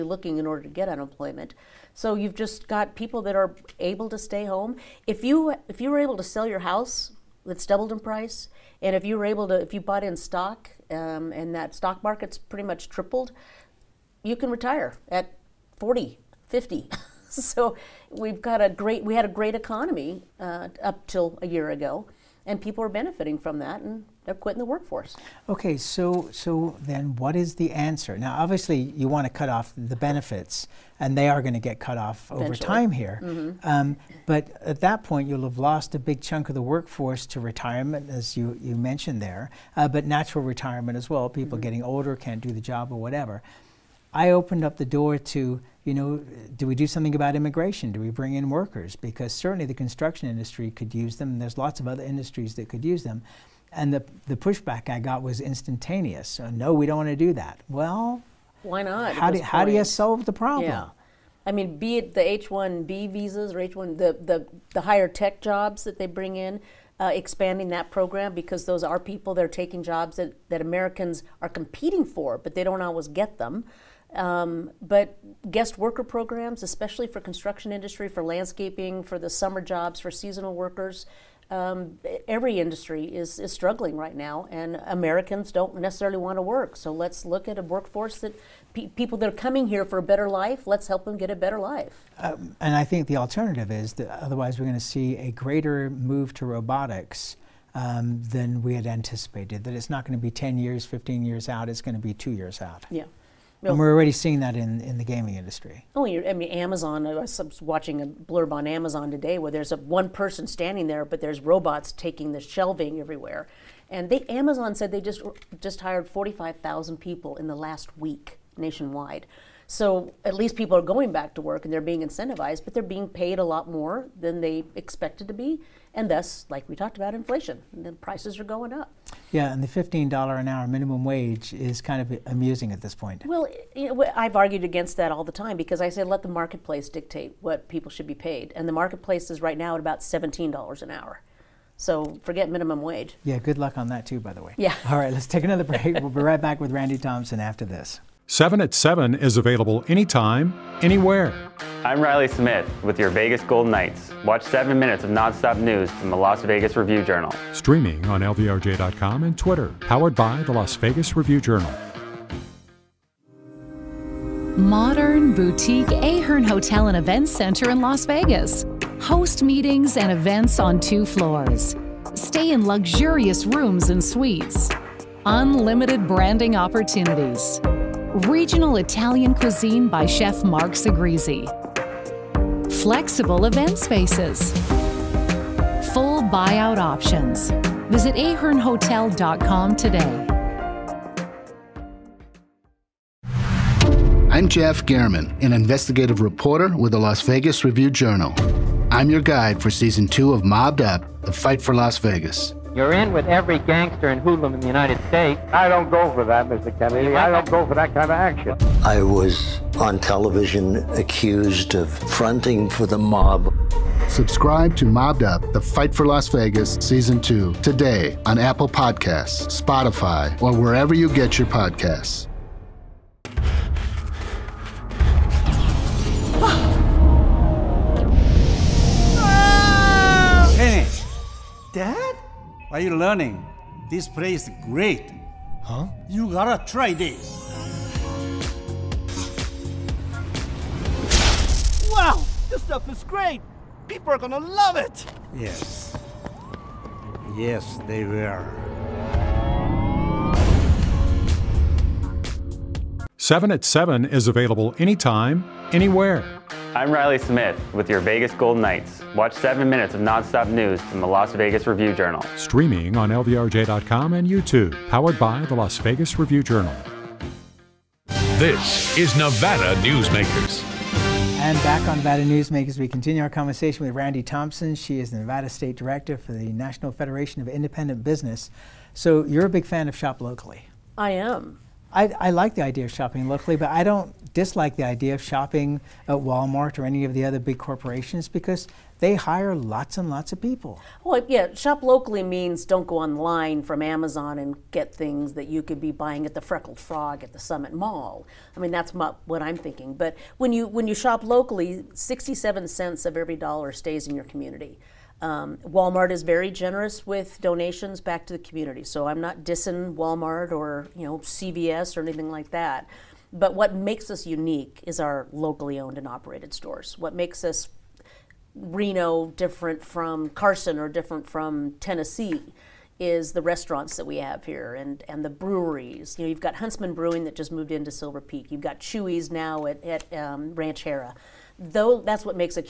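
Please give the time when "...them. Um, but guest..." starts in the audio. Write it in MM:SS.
01:13.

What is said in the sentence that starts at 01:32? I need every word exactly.
Um, and I think the alternative is that otherwise we're going to see a greater move to robotics.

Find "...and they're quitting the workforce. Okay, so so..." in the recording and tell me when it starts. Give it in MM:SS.
00:23.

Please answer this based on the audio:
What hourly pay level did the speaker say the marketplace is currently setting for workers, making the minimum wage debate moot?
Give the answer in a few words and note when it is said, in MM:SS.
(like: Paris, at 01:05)
$17, at 02:20.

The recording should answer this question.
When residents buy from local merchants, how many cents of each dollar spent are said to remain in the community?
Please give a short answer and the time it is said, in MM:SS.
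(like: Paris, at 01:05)
67, at 05:01.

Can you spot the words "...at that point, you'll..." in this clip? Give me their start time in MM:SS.
00:34.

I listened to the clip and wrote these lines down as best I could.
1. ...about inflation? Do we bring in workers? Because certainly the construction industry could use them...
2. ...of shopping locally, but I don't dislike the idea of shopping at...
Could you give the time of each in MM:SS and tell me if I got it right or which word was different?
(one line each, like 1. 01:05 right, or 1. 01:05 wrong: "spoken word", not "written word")
1. 00:47 wrong: "immigration", not "inflation"
2. 04:42 right.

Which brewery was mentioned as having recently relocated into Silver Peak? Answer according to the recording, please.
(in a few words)
Huntsman Brewing.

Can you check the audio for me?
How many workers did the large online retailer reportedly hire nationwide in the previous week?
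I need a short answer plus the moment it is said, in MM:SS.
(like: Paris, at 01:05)
45,000, at 01:56.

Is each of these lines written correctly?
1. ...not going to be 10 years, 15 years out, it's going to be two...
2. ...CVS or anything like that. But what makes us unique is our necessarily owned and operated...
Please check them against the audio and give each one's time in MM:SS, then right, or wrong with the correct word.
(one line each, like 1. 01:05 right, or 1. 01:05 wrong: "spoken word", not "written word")
1. 01:39 right
2. 05:11 wrong: "locally", not "necessarily".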